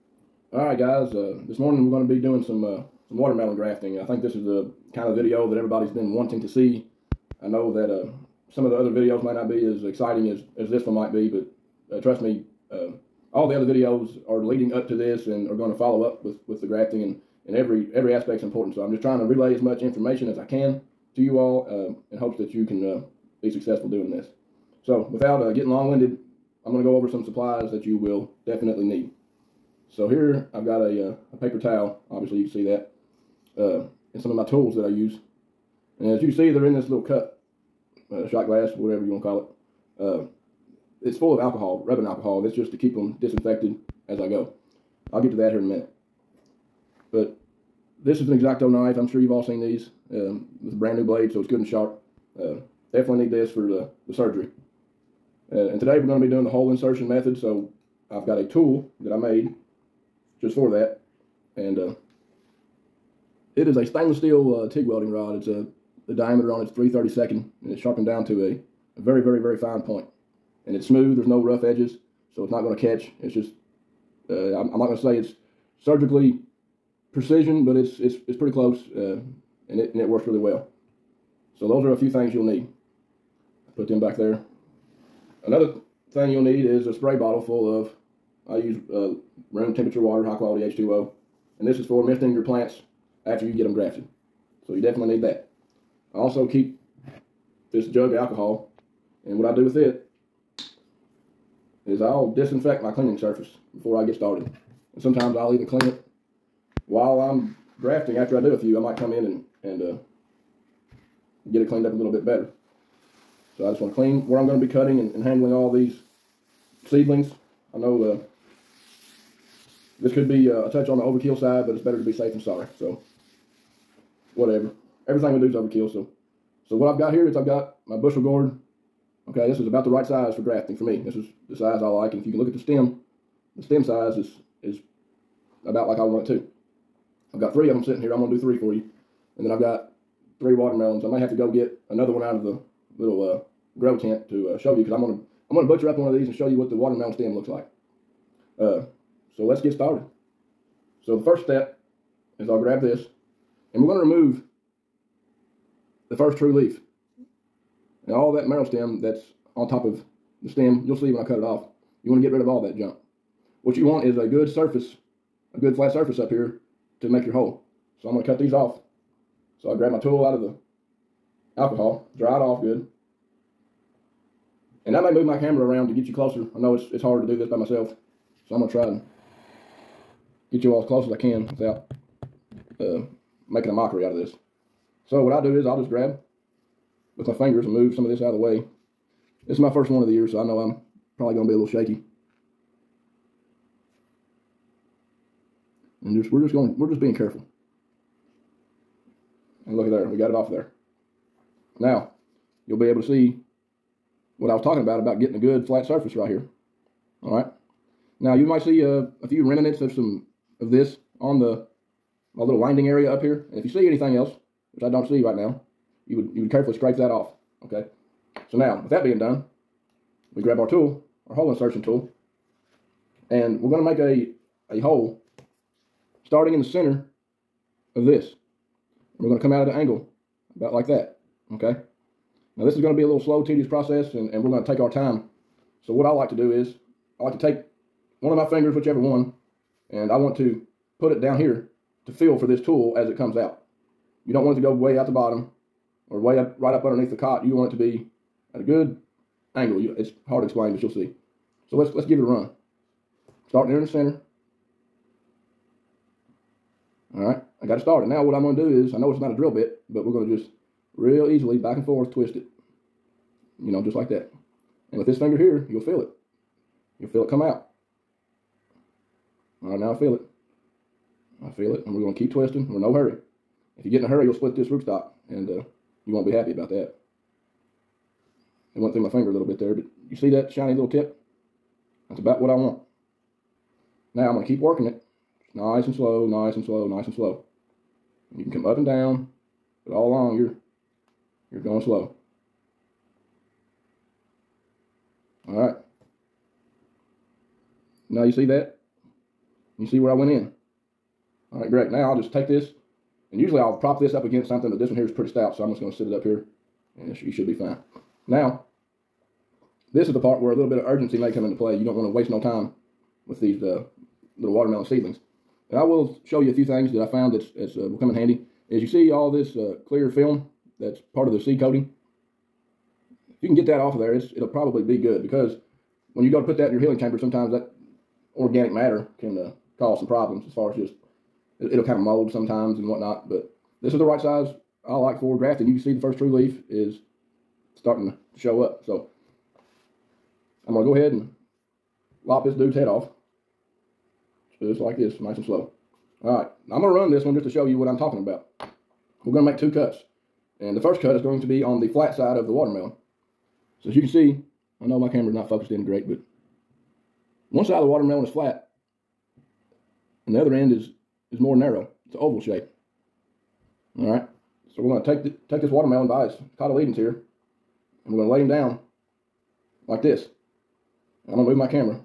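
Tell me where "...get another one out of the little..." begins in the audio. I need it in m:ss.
2:21.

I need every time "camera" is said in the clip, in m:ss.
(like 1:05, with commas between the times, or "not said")
2:55, 5:55.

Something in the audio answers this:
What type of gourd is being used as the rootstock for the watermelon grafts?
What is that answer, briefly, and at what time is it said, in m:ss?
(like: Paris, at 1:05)
Bushel gourd, at 2:07.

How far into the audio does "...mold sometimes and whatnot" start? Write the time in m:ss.
5:31.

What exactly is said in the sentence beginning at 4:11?
So let's let's give it a run.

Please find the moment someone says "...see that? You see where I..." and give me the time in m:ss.
4:58.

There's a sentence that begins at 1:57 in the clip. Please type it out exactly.
I know uh, this could be uh, a touch on the overkill side, but it's better to be safe than sorry.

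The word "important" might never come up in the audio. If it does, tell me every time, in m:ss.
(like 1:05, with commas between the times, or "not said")
0:18.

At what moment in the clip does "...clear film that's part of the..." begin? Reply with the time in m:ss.
5:19.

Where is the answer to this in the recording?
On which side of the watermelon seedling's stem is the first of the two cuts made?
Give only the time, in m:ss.
5:51.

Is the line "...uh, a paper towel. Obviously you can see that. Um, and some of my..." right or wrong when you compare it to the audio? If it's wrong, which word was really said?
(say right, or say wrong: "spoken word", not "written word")
right.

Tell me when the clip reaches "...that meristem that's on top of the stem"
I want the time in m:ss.
2:38.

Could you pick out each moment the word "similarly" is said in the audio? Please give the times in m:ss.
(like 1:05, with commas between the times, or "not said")
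not said.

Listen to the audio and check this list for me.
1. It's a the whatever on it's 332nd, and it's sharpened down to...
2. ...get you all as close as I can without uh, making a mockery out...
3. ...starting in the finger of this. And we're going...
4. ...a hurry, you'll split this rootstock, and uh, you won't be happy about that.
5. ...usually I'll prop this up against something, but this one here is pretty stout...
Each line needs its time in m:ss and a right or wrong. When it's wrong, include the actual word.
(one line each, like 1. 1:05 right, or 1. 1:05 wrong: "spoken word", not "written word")
1. 1:05 wrong: "diameter", not "whatever"
2. 3:00 right
3. 3:46 wrong: "center", not "finger"
4. 4:34 right
5. 5:03 right.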